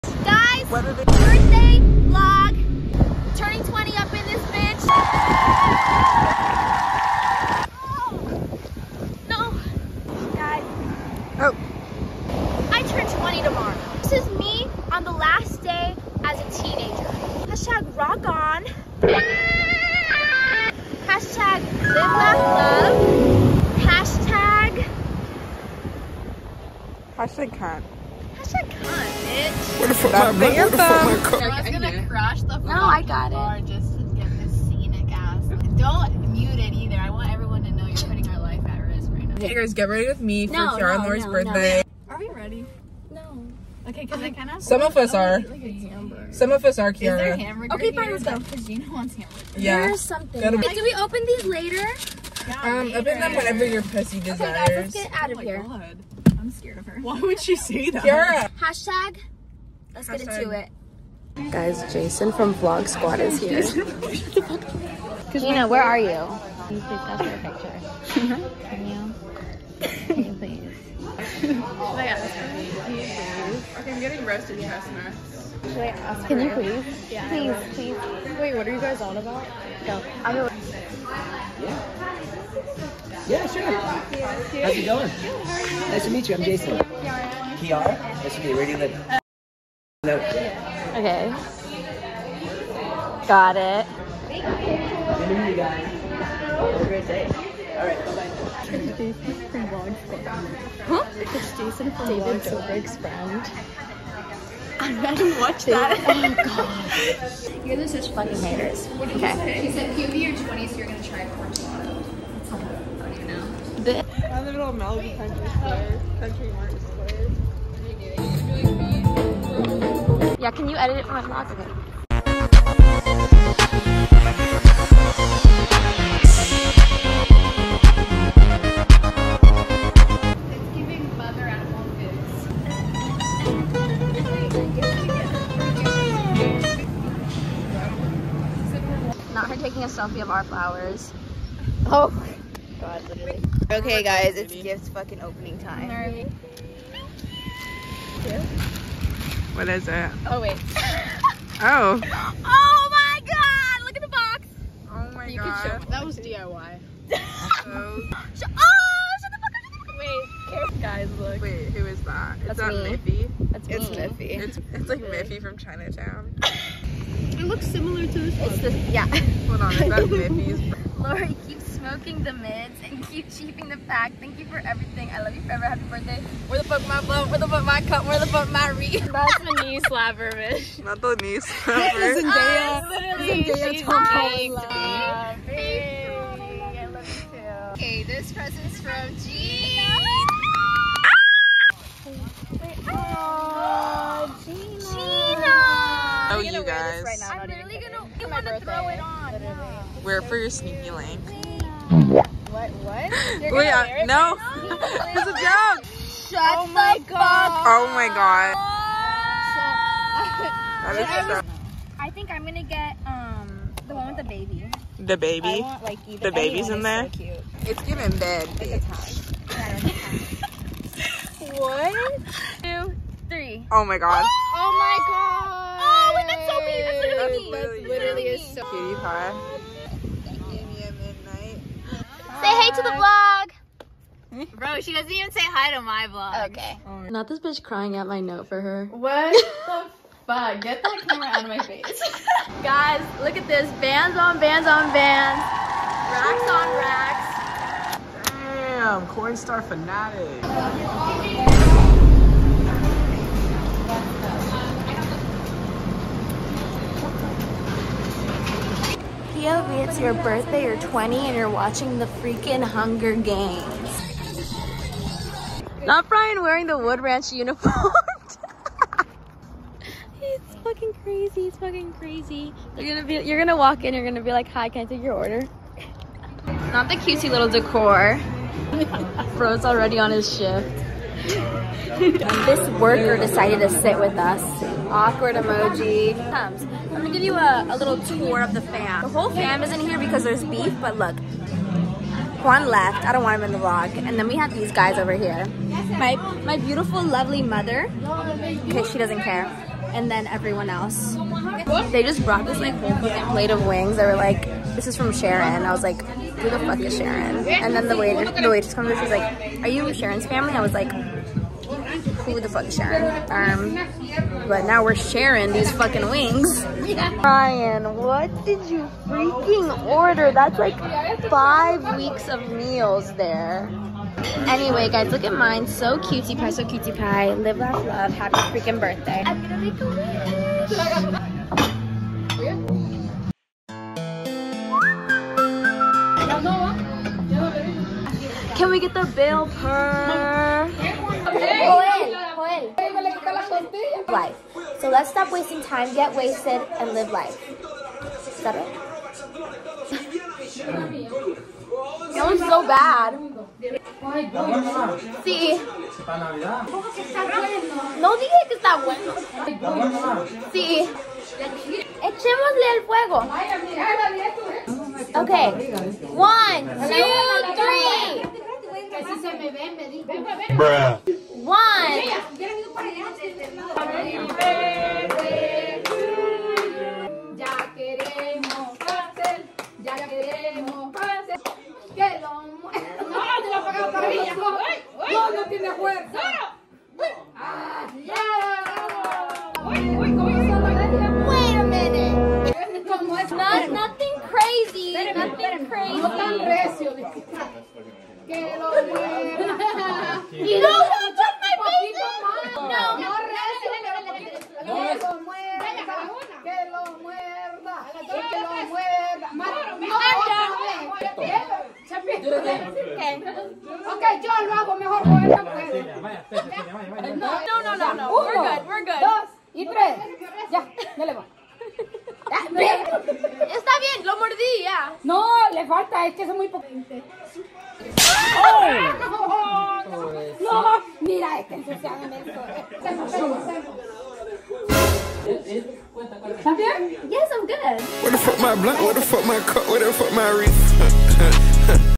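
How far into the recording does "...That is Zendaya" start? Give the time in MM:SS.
03:01.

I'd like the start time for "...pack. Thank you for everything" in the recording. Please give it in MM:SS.
02:53.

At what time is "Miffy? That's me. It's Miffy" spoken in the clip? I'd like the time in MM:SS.
02:43.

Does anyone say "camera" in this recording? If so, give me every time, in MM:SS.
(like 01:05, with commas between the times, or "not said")
04:01.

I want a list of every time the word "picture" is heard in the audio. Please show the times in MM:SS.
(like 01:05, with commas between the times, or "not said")
01:07.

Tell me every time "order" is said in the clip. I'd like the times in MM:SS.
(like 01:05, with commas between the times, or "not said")
04:35, 05:19.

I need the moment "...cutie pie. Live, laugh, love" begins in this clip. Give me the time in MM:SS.
05:26.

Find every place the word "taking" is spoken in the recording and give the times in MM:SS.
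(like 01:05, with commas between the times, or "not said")
02:19.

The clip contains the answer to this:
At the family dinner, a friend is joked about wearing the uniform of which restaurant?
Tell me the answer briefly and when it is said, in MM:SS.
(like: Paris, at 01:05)
Wood Ranch, at 04:26.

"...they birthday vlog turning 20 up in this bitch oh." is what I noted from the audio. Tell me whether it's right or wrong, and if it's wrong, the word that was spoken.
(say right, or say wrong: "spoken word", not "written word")
right.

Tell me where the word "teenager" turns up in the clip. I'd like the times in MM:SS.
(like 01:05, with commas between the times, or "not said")
00:16.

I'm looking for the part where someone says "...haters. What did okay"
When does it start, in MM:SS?
01:48.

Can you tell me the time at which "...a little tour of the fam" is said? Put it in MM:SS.
04:47.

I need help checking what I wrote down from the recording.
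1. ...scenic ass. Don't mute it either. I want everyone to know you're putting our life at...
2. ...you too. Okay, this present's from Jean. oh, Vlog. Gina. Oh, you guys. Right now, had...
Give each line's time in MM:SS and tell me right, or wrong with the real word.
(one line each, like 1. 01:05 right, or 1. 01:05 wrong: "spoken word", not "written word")
1. 00:34 right
2. 03:07 wrong: "Gina", not "Vlog".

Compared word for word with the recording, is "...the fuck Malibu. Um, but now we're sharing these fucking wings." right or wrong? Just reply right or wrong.
wrong.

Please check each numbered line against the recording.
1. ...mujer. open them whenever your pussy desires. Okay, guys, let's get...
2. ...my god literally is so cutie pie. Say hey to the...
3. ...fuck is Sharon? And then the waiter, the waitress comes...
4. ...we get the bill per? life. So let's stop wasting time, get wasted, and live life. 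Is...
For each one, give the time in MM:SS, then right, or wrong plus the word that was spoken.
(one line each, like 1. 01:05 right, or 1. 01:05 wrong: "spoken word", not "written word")
1. 00:52 wrong: "later", not "mujer"
2. 03:44 right
3. 05:06 right
4. 05:38 right.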